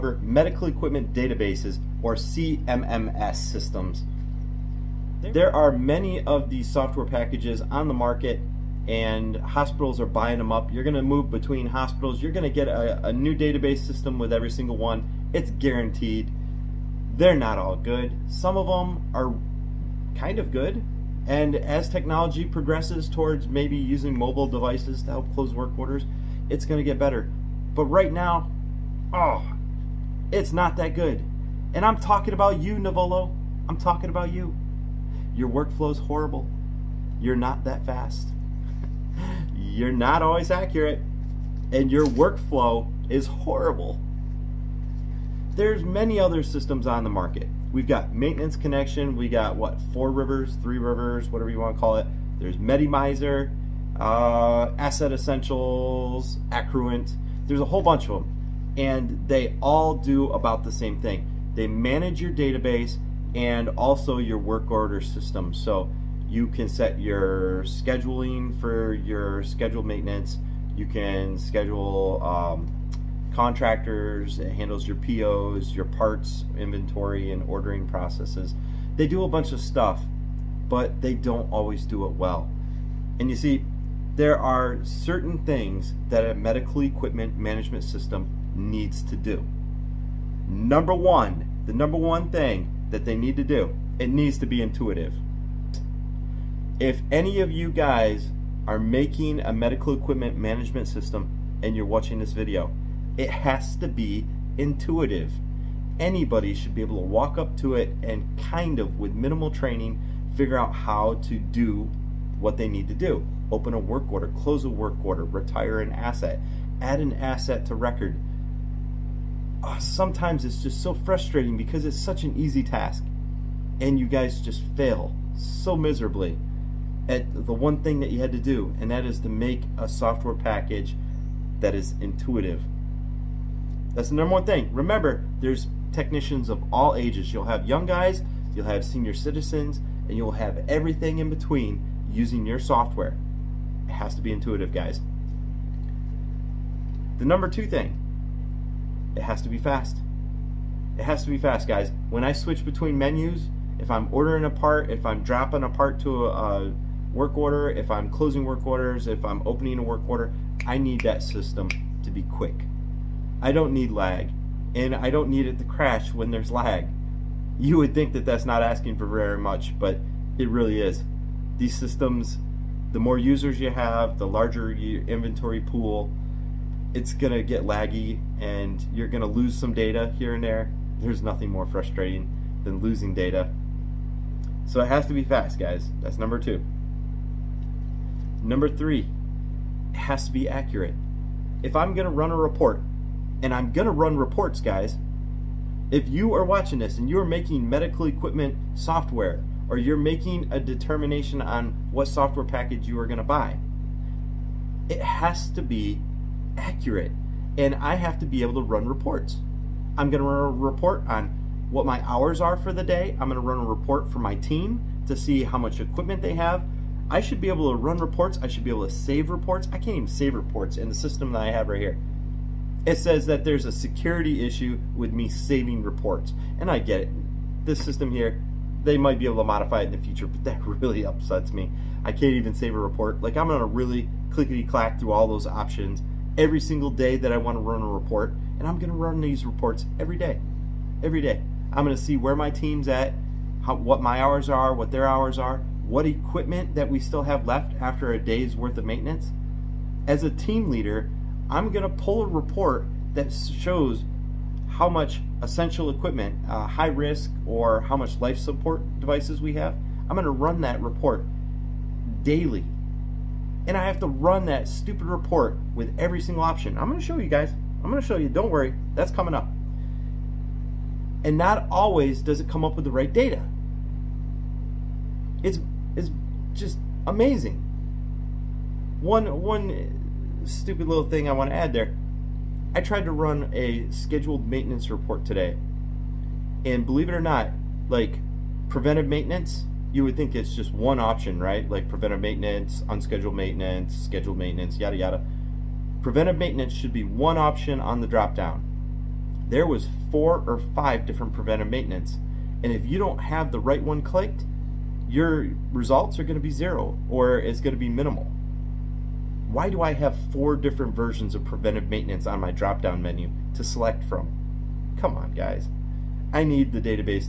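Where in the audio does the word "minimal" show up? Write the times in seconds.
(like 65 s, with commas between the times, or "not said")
109 s, 307 s.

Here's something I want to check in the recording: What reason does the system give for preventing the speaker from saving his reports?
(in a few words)
security issue.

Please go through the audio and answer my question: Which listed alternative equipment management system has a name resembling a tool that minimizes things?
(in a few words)
Medimizer.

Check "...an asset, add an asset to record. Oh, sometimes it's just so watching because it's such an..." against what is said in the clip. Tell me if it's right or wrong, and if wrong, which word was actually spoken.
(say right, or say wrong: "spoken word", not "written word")
wrong: "frustrating", not "watching".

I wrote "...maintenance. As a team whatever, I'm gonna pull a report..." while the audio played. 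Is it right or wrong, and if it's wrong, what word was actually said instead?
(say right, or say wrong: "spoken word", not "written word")
wrong: "leader", not "whatever".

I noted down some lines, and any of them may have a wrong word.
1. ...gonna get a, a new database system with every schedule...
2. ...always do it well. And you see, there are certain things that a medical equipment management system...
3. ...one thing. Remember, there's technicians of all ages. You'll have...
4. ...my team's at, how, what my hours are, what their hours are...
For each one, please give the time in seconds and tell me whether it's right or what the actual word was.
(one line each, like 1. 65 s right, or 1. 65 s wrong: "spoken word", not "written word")
1. 12 s wrong: "single", not "schedule"
2. 81 s right
3. 134 s right
4. 242 s right.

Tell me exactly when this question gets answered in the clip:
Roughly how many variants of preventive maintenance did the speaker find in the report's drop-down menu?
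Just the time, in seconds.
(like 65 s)
300 s.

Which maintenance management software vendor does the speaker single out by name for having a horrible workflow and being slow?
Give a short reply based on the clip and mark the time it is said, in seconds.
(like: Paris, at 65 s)
Nuvolo, at 32 s.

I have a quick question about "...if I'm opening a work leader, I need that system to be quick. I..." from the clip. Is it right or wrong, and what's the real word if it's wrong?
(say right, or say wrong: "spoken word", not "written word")
wrong: "order", not "leader".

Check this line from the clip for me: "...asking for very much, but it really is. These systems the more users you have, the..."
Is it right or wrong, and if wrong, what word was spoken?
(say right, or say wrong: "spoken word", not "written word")
right.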